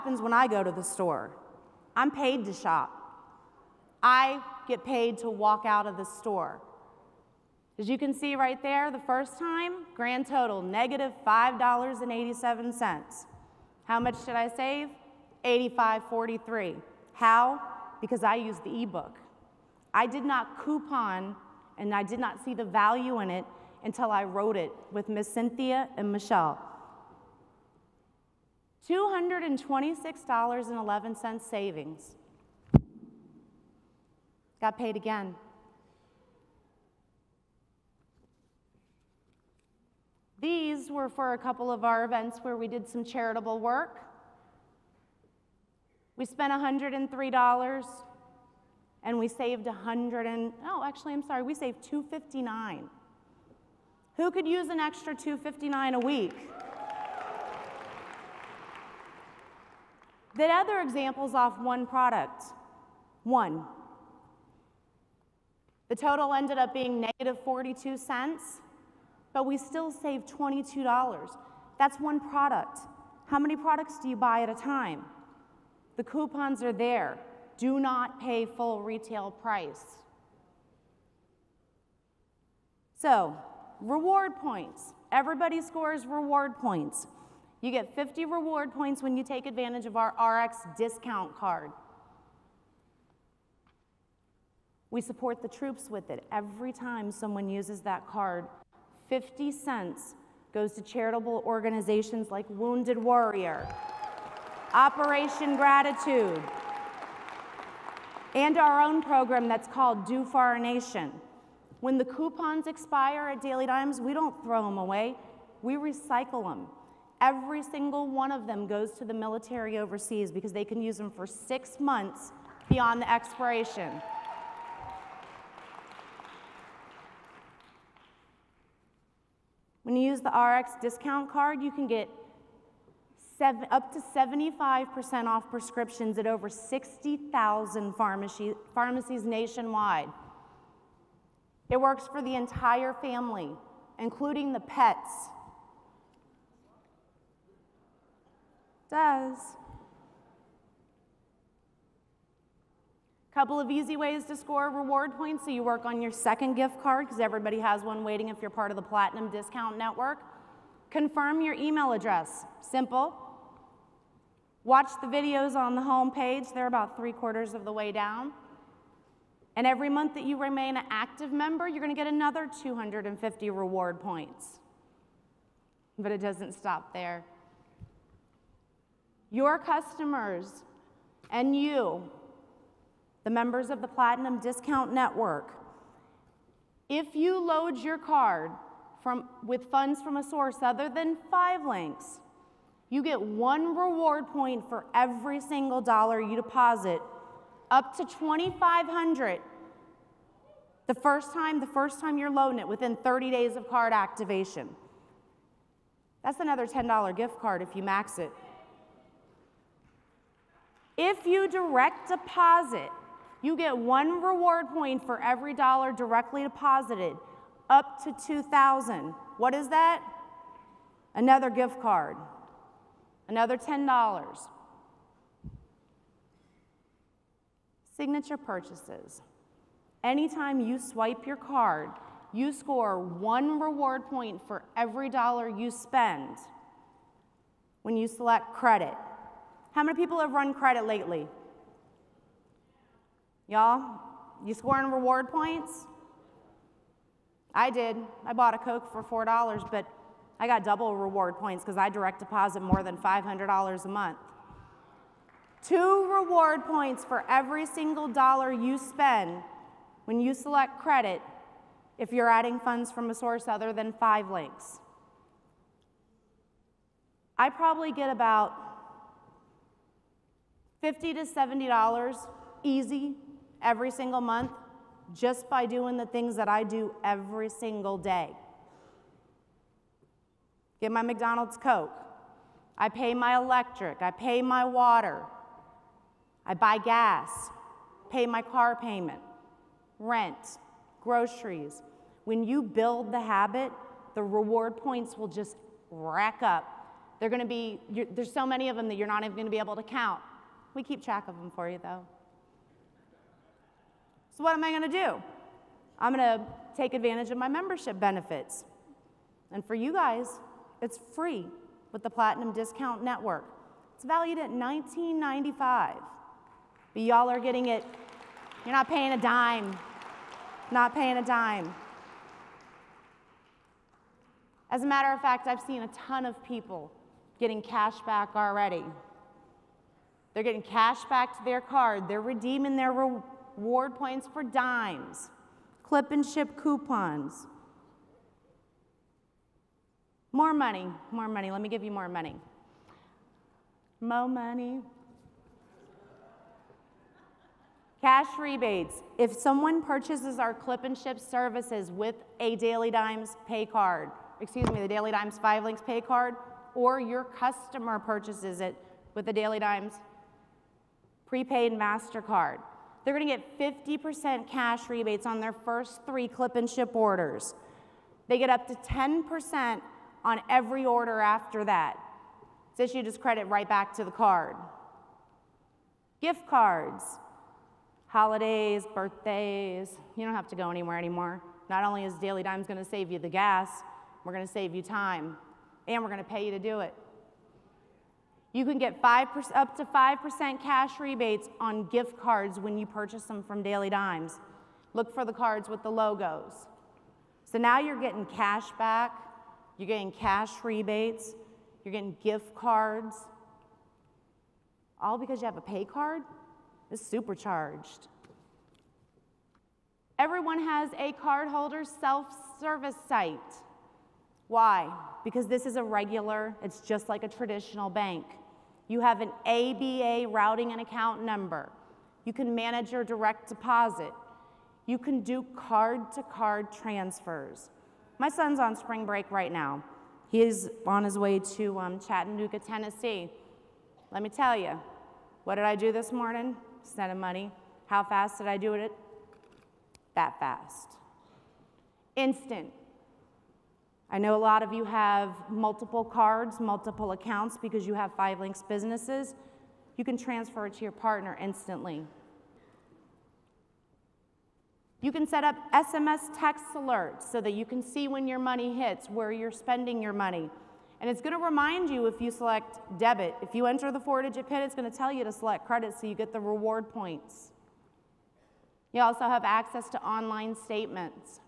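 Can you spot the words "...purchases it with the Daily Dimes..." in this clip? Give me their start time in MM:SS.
05:57.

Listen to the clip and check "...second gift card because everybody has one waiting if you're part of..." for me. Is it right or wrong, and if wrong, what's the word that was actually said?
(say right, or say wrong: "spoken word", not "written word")
right.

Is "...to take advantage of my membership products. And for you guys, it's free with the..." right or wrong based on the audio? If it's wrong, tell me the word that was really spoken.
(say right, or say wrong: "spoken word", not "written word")
wrong: "benefits", not "products".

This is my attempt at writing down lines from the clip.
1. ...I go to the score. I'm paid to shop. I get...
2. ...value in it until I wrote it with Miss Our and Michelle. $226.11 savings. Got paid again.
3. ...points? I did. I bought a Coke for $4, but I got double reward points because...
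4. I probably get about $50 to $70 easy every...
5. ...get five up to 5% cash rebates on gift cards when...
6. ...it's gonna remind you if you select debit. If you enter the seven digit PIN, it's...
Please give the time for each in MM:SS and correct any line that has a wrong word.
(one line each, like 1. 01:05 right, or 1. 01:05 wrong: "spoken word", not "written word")
1. 00:00 wrong: "store", not "score"
2. 00:22 wrong: "Cynthia", not "Our"
3. 04:05 right
4. 04:27 right
5. 06:28 right
6. 07:41 wrong: "four", not "seven".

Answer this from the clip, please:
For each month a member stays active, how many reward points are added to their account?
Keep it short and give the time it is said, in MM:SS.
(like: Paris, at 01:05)
250, at 02:52.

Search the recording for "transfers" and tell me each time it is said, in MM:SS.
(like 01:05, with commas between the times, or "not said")
07:06, 07:30.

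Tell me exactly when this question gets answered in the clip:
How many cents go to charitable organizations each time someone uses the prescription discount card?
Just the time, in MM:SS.
01:39.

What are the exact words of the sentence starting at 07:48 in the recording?
You also have access to online statements.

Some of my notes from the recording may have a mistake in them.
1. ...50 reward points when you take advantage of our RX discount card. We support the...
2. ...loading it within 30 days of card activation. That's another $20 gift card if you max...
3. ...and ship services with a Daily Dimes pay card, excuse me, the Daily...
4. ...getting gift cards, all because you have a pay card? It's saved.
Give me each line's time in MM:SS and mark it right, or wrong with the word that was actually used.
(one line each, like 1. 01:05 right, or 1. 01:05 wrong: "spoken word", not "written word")
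1. 01:27 right
2. 03:22 wrong: "10", not "20"
3. 05:50 right
4. 06:41 wrong: "supercharged", not "saved".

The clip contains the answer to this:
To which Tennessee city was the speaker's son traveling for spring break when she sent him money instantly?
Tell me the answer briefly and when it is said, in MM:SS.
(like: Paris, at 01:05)
Chattanooga, at 07:11.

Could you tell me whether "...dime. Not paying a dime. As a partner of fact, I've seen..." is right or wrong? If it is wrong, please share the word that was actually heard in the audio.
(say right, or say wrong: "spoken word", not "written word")
wrong: "matter", not "partner".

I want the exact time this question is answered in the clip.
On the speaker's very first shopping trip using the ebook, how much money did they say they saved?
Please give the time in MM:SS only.
00:15.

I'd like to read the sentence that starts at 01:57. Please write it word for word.
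Every single one of them goes to the military overseas because they can use them for six months beyond the expiration.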